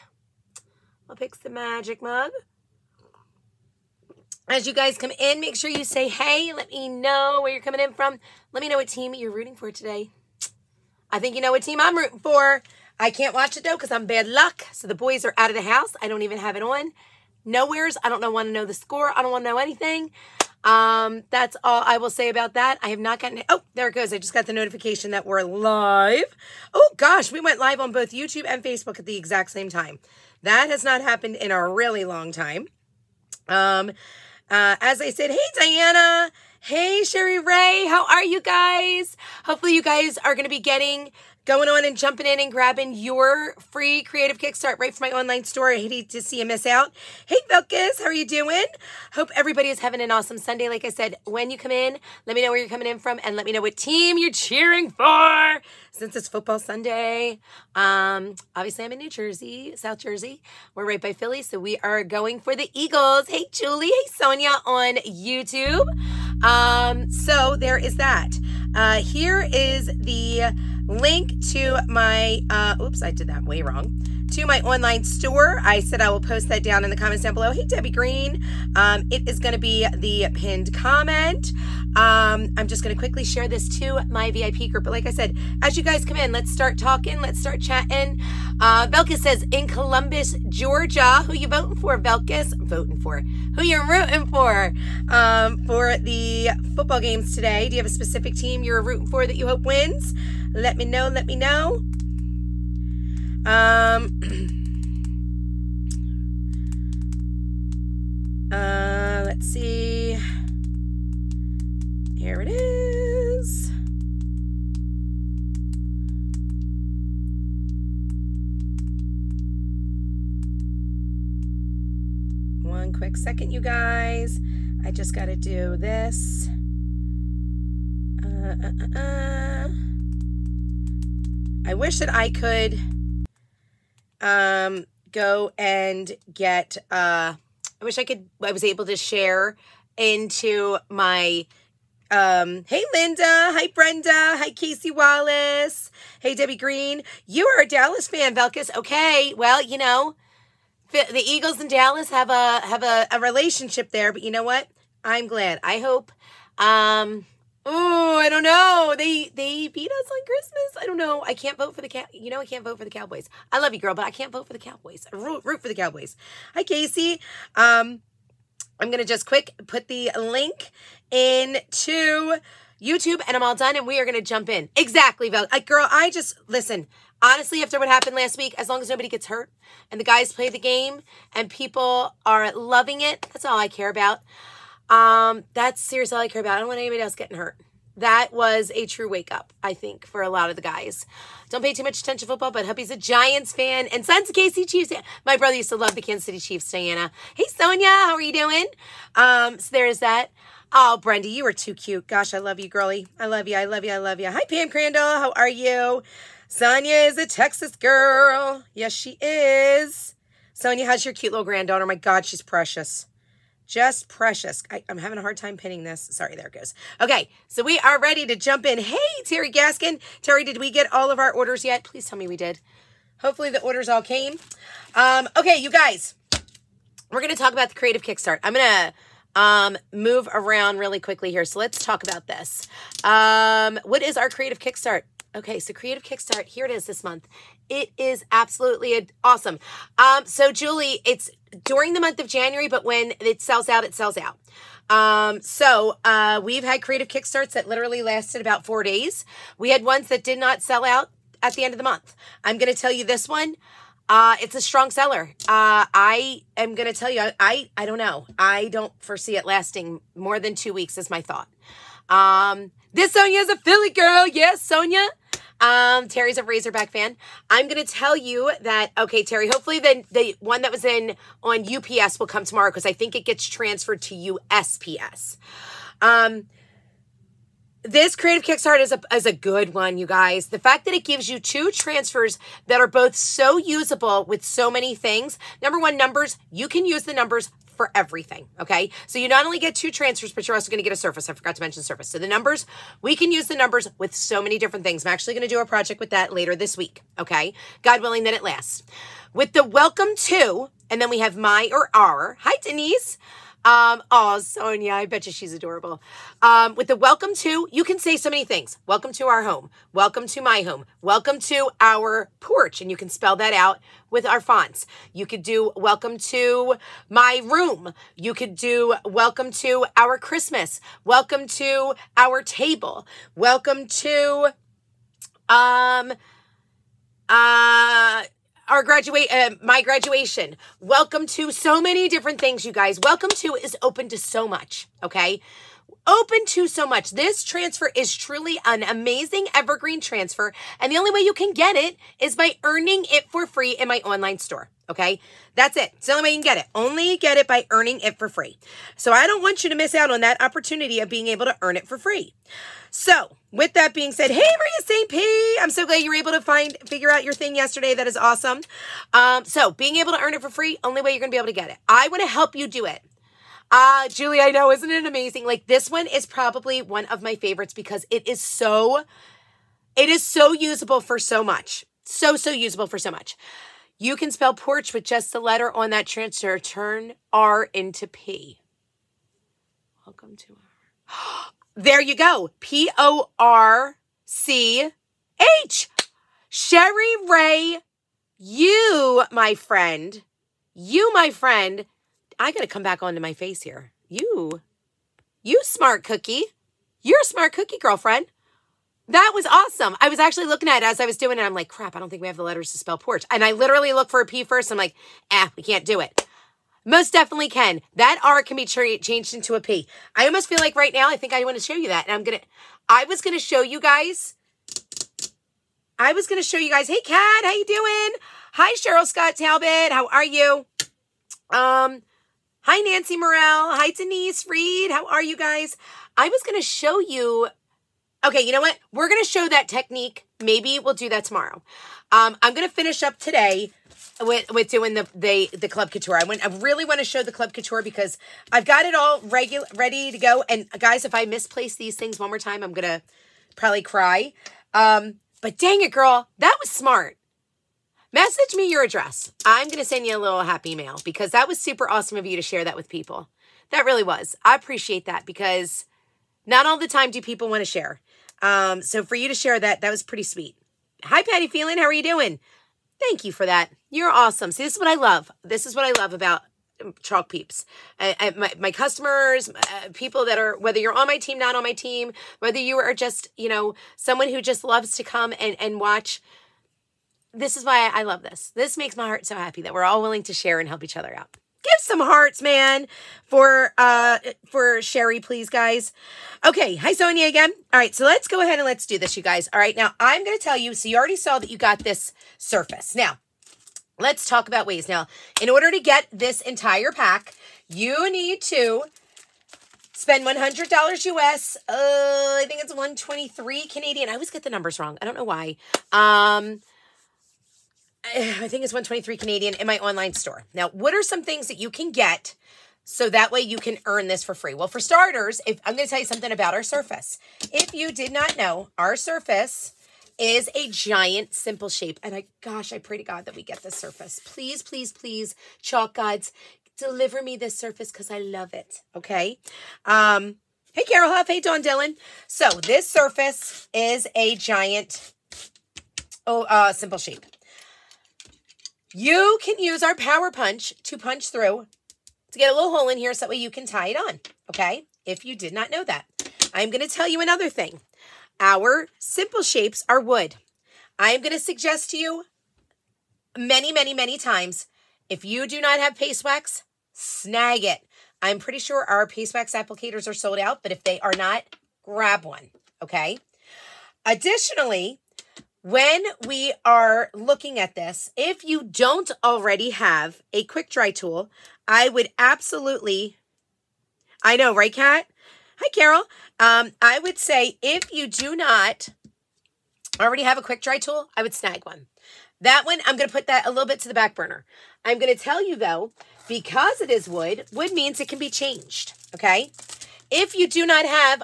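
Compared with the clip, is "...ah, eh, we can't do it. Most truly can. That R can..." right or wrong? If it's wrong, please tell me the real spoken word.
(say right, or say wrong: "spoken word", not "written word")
wrong: "definitely", not "truly".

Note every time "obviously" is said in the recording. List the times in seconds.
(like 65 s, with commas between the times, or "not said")
58 s.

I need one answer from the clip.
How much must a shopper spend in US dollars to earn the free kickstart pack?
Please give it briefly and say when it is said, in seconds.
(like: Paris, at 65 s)
$100, at 500 s.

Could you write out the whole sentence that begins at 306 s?
Um, with the welcome to, you can say so many things.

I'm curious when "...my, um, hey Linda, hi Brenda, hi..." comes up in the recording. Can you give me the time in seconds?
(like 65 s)
140 s.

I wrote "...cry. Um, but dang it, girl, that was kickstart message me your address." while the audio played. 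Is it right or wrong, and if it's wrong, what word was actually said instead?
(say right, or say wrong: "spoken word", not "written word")
wrong: "smart", not "kickstart".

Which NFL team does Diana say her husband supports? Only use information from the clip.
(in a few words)
Giants.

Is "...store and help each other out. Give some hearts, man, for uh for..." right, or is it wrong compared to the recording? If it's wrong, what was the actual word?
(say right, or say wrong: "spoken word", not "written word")
wrong: "share", not "store".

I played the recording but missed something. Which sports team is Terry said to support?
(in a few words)
Razorback.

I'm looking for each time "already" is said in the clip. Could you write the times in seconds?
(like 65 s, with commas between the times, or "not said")
490 s, 569 s, 580 s.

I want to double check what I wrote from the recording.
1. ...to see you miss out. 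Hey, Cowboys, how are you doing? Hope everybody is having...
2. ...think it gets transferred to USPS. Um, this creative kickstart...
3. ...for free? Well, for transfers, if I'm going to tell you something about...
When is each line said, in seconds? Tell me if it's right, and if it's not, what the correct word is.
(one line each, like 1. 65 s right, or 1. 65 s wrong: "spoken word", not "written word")
1. 46 s wrong: "Vilkas", not "Cowboys"
2. 272 s right
3. 514 s wrong: "starters", not "transfers".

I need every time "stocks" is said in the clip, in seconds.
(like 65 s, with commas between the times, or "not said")
not said.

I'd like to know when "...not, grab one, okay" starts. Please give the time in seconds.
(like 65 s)
561 s.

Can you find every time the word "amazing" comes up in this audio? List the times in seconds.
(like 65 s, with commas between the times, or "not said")
338 s, 365 s.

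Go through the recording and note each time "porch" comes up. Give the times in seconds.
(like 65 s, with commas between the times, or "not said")
312 s, 374 s, 402 s.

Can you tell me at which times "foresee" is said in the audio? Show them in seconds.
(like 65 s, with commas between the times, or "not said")
259 s.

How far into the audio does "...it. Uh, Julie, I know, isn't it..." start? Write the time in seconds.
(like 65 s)
362 s.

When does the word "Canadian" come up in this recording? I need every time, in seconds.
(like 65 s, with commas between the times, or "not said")
503 s, 509 s.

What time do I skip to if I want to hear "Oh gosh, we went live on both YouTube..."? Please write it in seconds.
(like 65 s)
26 s.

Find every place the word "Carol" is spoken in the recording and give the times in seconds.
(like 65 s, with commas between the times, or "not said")
530 s, 575 s.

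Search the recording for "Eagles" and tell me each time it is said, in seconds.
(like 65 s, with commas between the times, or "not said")
62 s, 151 s.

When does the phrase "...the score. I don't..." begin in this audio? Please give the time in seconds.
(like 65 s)
18 s.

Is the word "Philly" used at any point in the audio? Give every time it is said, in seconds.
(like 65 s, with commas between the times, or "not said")
61 s, 263 s.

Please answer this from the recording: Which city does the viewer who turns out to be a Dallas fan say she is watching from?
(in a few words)
Columbus, Georgia.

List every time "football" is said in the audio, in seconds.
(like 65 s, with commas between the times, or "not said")
56 s, 96 s, 192 s.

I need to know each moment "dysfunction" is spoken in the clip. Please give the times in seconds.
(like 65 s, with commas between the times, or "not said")
not said.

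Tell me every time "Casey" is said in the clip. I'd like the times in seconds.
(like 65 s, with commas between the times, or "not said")
144 s, 166 s.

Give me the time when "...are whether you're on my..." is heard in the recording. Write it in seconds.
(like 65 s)
470 s.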